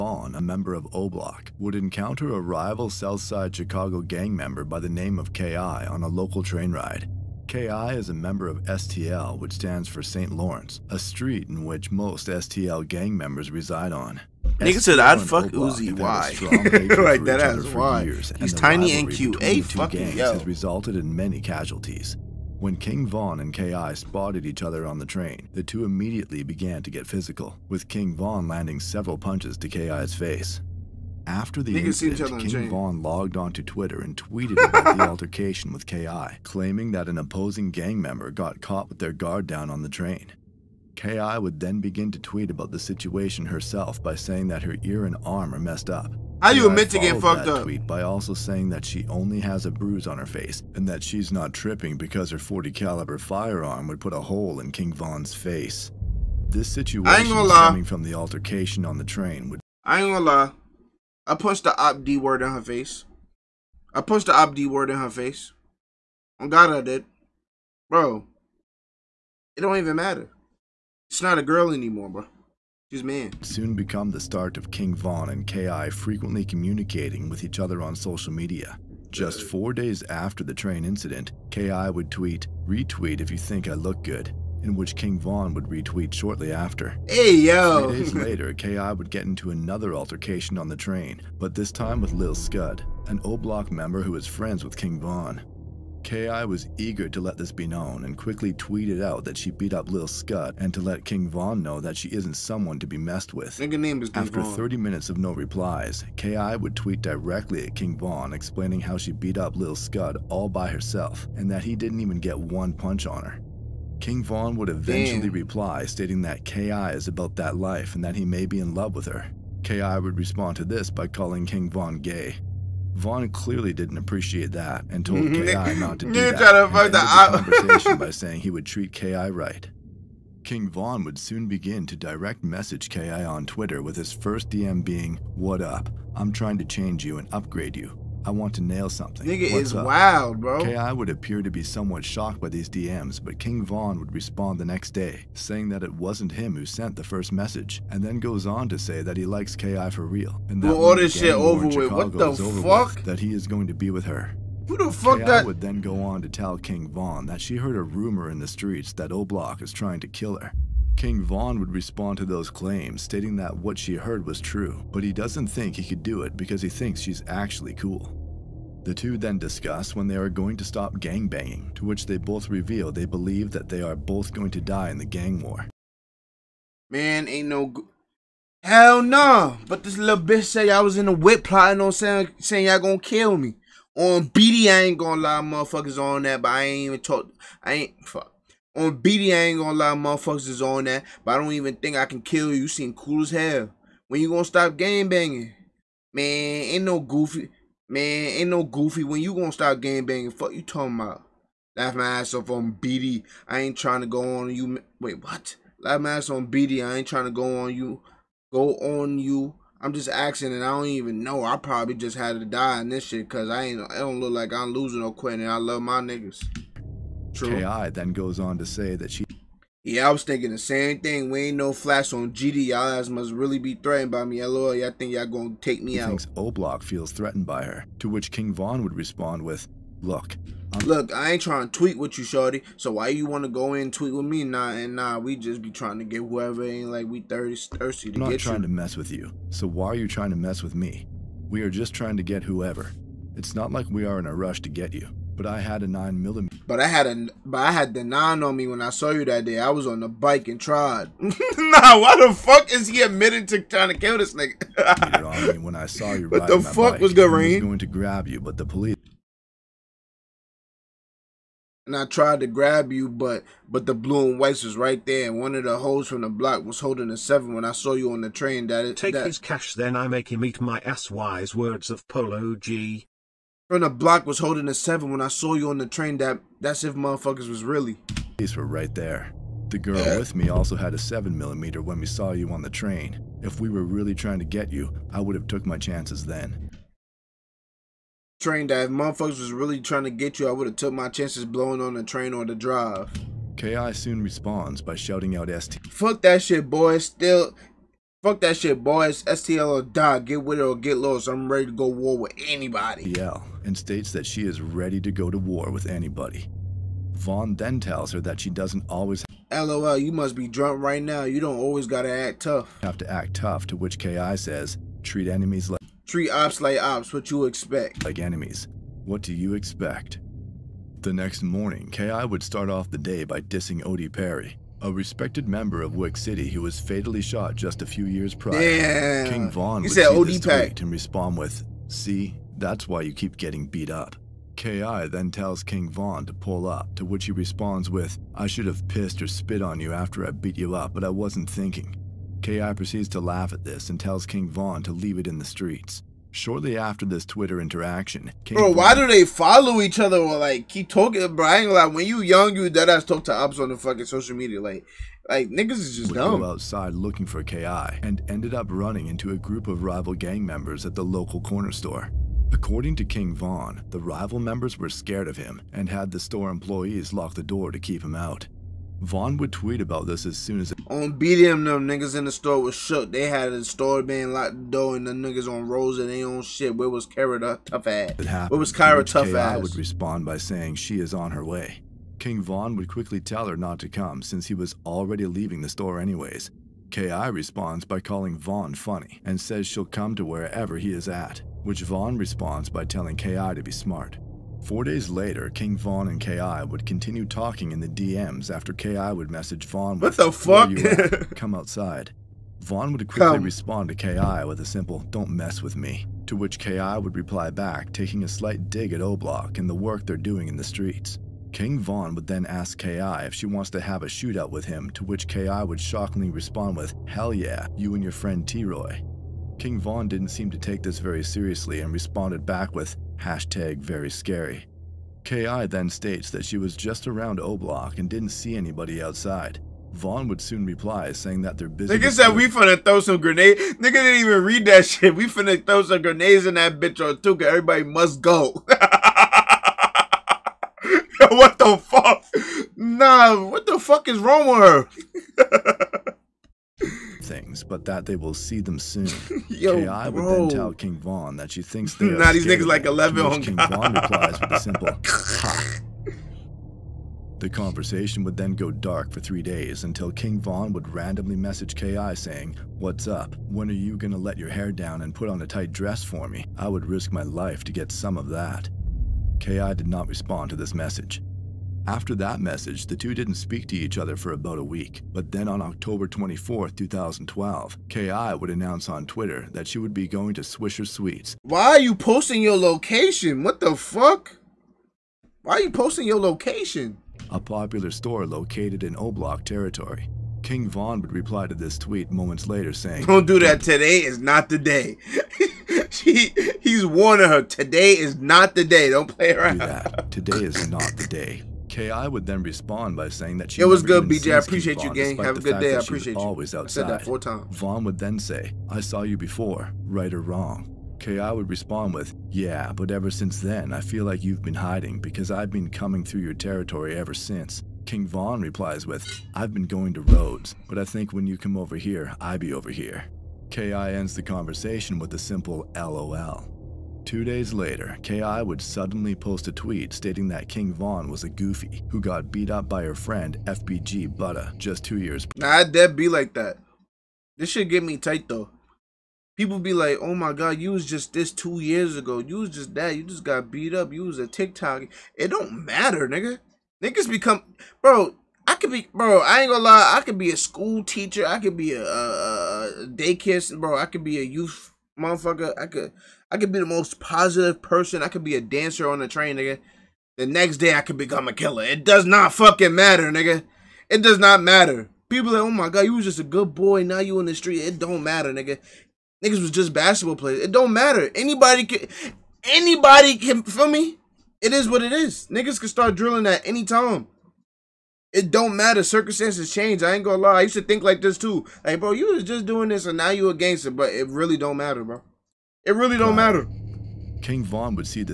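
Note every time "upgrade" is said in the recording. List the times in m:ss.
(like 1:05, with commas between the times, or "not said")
2:17.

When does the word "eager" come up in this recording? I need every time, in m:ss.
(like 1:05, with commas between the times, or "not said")
1:36.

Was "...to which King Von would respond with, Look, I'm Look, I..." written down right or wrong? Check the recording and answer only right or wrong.
right.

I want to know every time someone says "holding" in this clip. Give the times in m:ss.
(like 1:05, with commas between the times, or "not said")
4:26, 4:34.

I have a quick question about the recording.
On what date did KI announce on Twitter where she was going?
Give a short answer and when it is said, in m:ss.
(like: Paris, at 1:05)
October 24, 2012, at 7:55.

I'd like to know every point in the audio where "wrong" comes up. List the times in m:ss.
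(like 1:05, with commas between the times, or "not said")
7:24, 8:30.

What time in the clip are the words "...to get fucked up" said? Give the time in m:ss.
0:46.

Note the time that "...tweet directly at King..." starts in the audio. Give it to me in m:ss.
1:46.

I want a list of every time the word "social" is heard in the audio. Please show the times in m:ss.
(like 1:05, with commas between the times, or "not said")
1:17, 5:54.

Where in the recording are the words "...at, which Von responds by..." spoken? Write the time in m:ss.
6:31.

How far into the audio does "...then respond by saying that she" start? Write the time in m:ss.
8:22.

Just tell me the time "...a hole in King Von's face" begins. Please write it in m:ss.
0:54.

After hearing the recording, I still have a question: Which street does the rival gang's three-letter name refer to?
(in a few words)
St. Lawrence.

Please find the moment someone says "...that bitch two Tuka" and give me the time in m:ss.
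7:16.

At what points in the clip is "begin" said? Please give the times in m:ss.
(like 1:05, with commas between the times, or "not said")
0:41, 2:11.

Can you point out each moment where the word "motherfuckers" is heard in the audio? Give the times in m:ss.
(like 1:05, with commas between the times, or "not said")
3:05, 3:09, 4:36, 4:48, 9:15.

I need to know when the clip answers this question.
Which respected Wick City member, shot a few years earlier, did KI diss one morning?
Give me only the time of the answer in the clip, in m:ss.
5:23.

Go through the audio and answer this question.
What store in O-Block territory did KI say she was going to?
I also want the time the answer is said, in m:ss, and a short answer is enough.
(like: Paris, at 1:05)
Swisher Suites, at 8:00.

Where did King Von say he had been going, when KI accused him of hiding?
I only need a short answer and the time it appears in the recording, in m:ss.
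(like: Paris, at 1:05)
Rhodes, at 8:40.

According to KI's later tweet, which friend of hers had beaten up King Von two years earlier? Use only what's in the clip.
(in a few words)
FBG Butta.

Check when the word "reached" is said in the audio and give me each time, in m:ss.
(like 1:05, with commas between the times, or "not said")
not said.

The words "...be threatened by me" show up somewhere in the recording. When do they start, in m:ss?
3:43.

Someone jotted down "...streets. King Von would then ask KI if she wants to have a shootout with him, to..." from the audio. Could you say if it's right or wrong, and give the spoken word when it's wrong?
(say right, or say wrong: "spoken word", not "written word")
right.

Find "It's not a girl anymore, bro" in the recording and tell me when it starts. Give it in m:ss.
1:11.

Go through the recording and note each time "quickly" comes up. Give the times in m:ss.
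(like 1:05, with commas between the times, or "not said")
1:38, 6:22, 6:43.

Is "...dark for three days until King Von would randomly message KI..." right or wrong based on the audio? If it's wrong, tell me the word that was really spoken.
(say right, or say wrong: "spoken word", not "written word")
right.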